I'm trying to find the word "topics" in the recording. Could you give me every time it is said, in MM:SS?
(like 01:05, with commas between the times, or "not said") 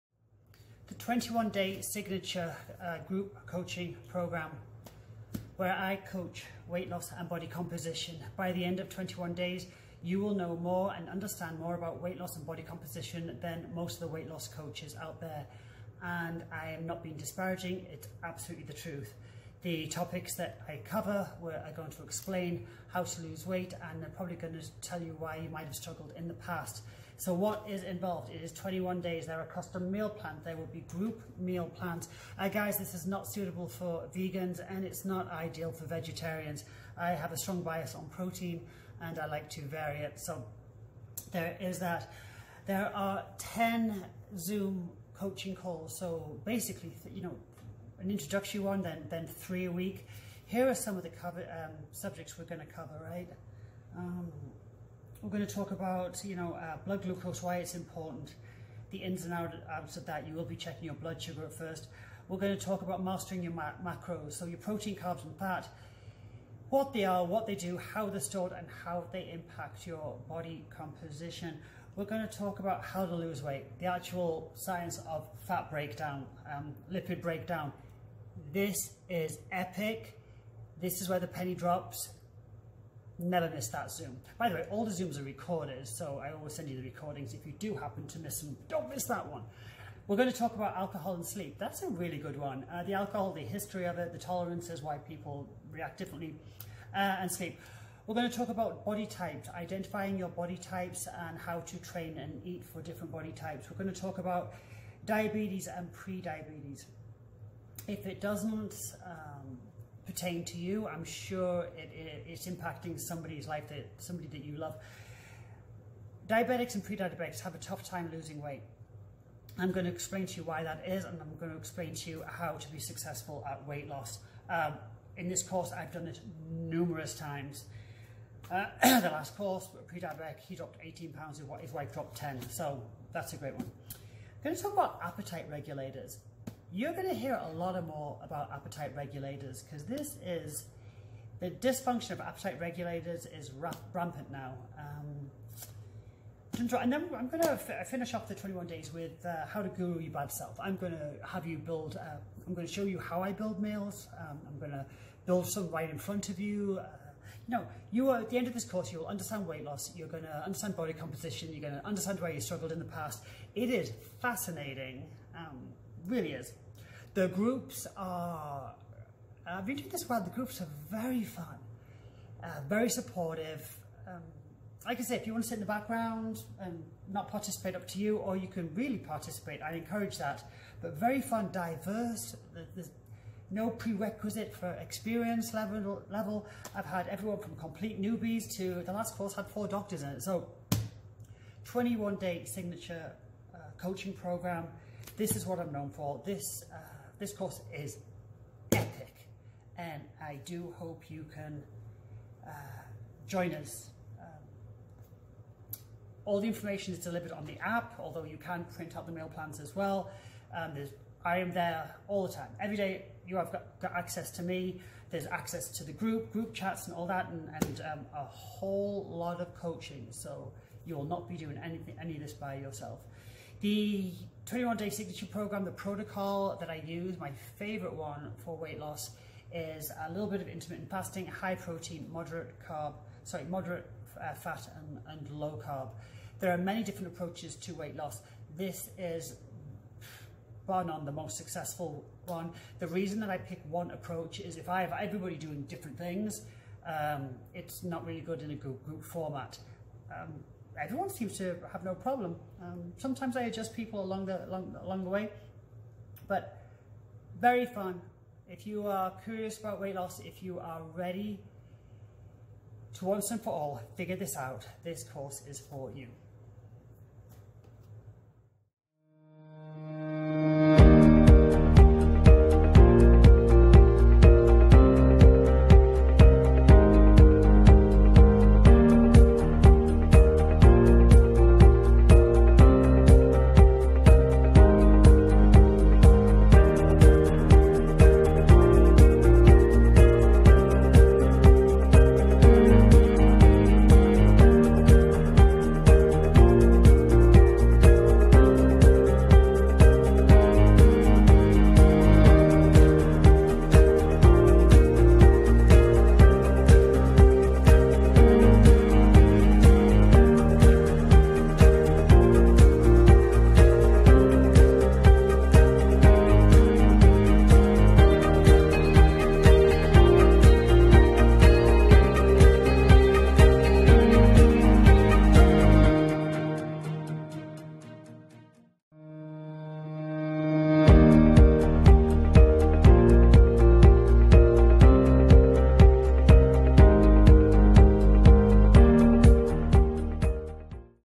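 00:19.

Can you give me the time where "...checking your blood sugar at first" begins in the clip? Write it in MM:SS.
01:00.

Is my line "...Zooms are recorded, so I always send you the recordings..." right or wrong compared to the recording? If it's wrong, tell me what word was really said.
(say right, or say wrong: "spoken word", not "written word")
right.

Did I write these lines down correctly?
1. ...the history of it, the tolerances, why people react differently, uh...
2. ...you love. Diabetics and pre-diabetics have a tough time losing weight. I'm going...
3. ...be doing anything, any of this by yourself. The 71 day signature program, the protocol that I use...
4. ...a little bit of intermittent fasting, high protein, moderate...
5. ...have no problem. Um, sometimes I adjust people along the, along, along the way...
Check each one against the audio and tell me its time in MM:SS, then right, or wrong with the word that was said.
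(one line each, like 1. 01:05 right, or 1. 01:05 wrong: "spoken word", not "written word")
1. 01:33 right
2. 01:54 right
3. 03:41 wrong: "21", not "71"
4. 03:50 right
5. 04:11 right.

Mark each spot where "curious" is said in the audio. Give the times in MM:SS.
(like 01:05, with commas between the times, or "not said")
04:19.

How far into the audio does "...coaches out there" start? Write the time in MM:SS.
00:14.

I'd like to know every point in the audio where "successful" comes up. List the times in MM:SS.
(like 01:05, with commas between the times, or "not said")
02:02, 04:01.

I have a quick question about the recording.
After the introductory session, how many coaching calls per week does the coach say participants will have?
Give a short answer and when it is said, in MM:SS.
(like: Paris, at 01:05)
3, at 00:49.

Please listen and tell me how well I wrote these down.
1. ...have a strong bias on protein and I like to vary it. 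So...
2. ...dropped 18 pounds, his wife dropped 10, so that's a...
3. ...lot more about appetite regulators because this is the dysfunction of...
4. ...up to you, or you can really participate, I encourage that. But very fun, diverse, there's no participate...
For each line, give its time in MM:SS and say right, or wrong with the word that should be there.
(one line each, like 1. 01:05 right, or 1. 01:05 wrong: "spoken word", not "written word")
1. 00:37 right
2. 02:10 right
3. 02:17 right
4. 02:57 wrong: "prerequisite", not "participate".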